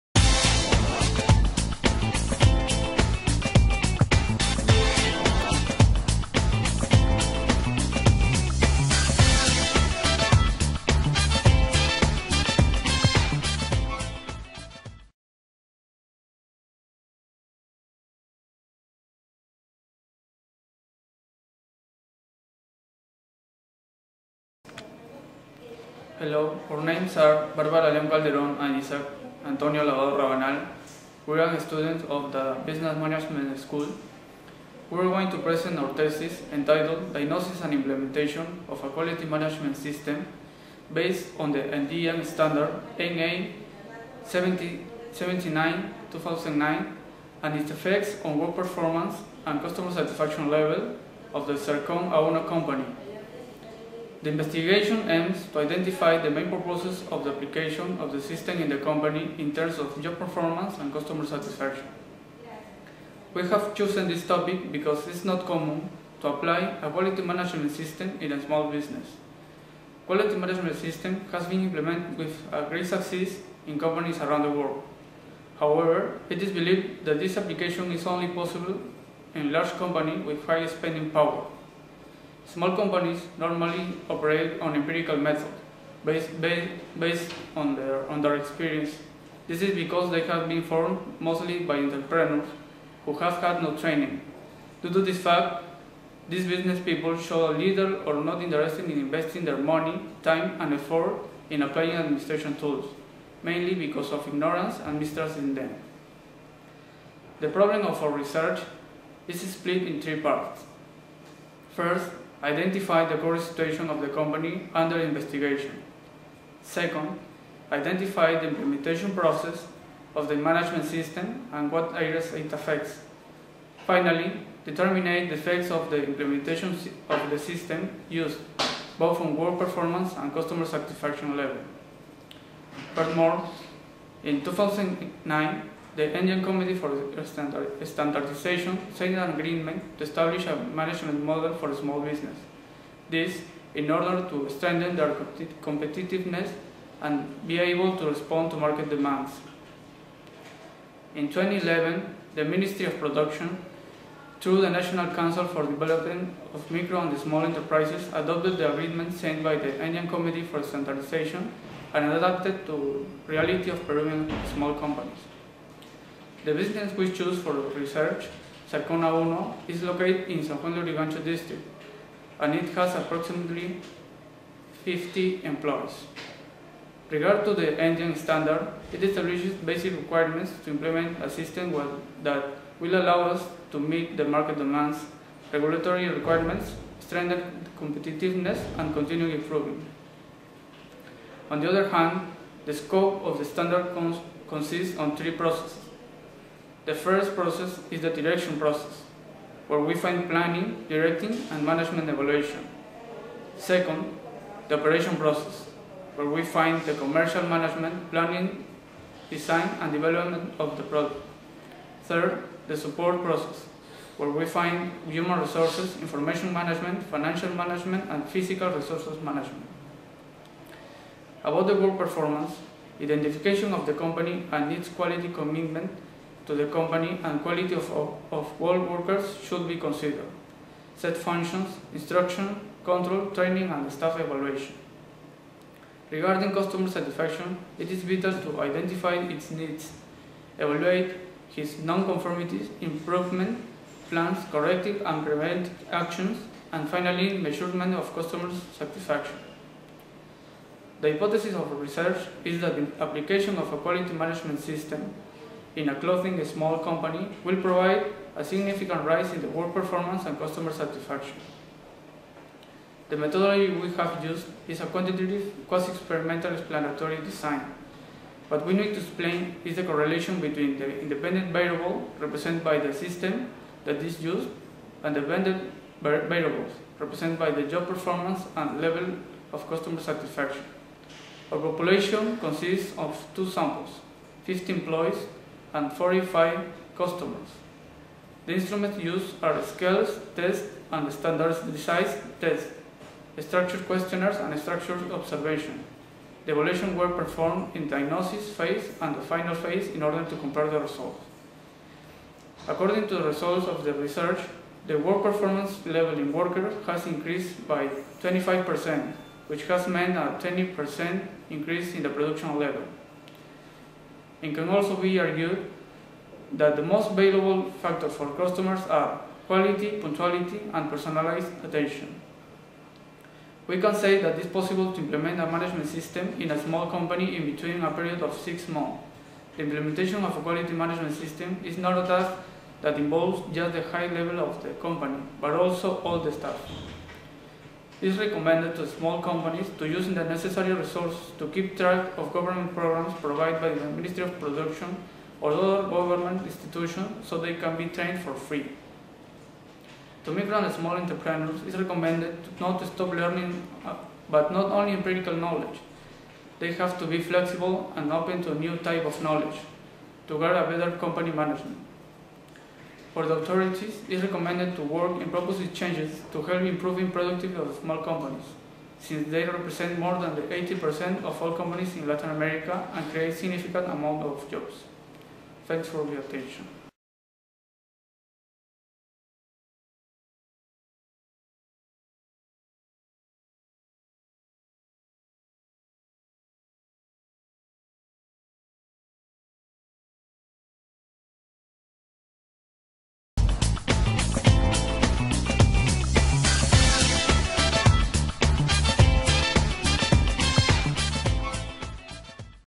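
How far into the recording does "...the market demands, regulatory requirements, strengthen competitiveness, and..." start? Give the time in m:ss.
3:04.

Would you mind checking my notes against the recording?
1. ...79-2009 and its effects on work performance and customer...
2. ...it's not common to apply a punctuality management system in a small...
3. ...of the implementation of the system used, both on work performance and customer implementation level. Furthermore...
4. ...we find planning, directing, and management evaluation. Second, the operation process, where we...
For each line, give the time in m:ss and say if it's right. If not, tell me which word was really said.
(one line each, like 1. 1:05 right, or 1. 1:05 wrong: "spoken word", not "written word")
1. 0:44 right
2. 1:05 wrong: "quality", not "punctuality"
3. 2:05 wrong: "satisfaction", not "implementation"
4. 3:19 right.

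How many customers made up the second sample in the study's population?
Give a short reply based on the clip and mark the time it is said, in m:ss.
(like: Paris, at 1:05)
45, at 4:45.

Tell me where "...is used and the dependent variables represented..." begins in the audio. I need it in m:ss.
4:33.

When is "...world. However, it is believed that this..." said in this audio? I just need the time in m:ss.
1:14.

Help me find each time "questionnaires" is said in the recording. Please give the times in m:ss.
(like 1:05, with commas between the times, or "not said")
4:53.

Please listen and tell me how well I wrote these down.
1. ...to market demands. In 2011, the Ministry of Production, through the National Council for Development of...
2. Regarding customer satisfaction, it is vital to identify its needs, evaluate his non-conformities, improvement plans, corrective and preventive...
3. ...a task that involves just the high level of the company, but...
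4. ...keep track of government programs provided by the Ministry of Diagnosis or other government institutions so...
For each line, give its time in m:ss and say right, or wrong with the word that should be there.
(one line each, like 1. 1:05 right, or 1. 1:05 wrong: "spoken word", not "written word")
1. 2:28 right
2. 3:56 right
3. 5:32 right
4. 5:41 wrong: "Production", not "Diagnosis".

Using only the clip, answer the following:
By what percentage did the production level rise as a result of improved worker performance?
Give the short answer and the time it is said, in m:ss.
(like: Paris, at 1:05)
20%, at 5:10.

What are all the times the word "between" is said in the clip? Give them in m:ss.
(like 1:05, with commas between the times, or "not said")
4:30, 5:27.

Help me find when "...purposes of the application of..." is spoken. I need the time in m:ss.
0:56.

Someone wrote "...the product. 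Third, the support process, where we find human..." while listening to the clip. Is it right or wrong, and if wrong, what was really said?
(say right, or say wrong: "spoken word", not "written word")
right.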